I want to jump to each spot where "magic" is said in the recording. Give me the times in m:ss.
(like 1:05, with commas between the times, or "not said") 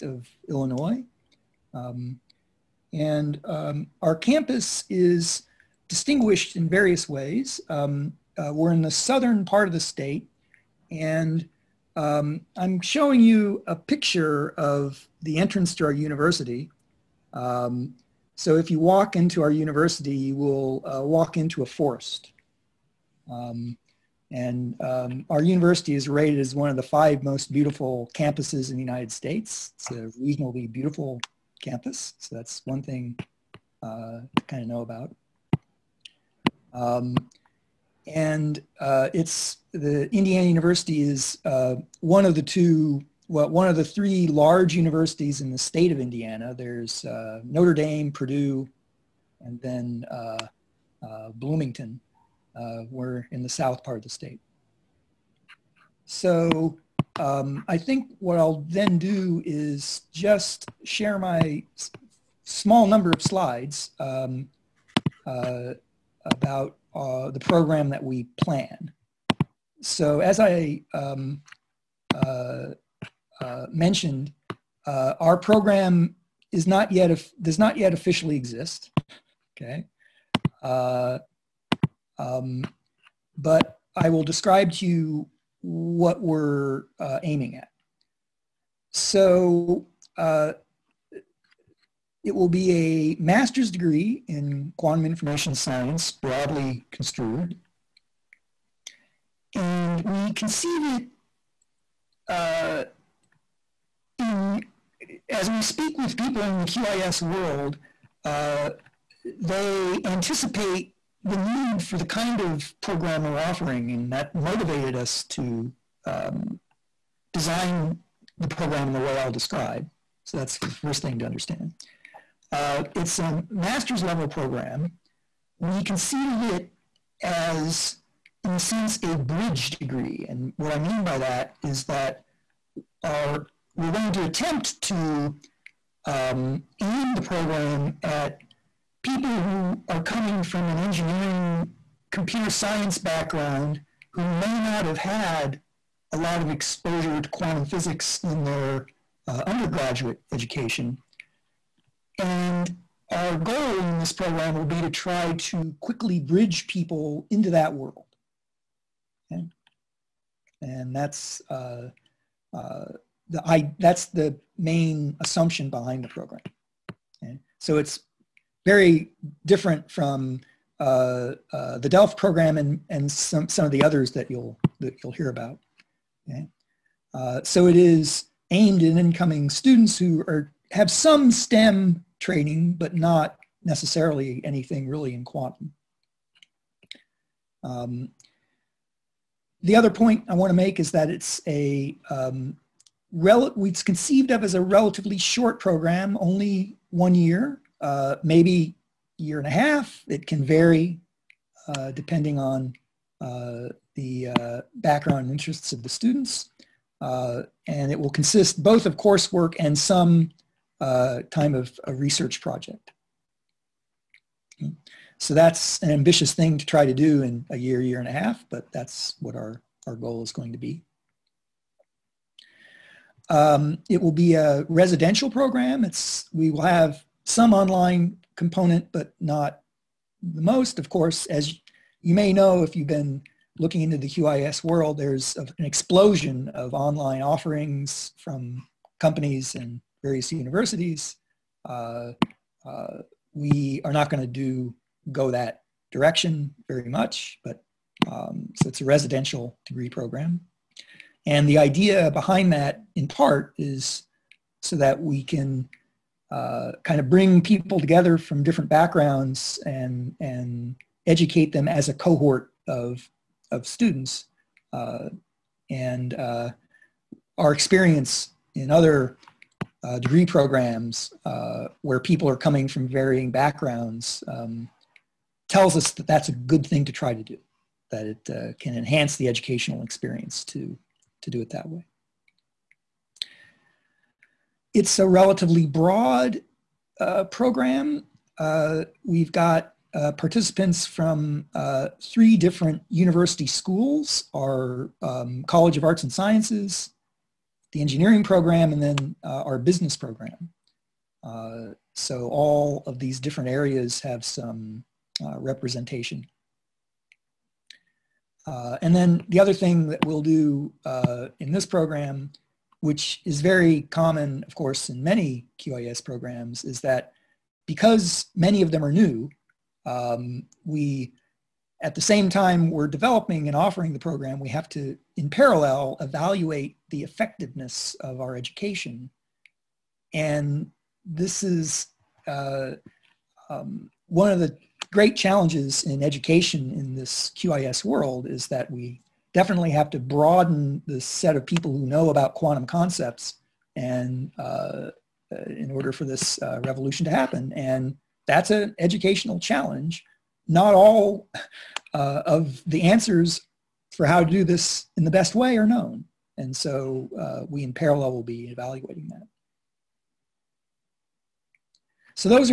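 not said.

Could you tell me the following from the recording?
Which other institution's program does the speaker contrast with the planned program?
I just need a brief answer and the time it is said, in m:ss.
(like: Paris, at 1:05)
Delft, at 2:51.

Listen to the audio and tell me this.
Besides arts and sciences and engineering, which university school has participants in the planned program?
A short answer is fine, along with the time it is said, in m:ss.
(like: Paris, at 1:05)
Business, at 4:59.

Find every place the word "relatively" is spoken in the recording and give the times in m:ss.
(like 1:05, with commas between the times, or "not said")
3:14, 4:45.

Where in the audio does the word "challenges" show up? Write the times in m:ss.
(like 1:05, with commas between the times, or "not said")
5:35, 5:49.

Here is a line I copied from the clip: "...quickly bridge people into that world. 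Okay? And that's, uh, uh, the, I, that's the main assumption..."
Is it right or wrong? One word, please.
right.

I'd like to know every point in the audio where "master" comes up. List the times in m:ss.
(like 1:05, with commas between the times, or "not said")
1:33, 2:03.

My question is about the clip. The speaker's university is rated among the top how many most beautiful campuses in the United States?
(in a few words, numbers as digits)
5.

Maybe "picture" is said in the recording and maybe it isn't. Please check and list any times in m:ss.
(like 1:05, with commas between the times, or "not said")
0:13.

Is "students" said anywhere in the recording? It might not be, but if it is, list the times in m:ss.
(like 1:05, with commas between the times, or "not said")
2:59, 3:25, 4:23.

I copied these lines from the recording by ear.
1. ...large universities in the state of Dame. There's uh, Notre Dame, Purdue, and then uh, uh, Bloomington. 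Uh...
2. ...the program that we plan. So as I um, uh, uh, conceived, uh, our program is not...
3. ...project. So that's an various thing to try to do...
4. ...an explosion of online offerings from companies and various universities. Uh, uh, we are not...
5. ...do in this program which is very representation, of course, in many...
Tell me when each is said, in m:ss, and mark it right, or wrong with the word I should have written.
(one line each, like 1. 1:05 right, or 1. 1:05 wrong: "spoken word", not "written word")
1. 0:44 wrong: "Indiana", not "Dame"
2. 1:07 wrong: "mentioned", not "conceived"
3. 3:32 wrong: "ambitious", not "various"
4. 3:55 right
5. 5:10 wrong: "common", not "representation".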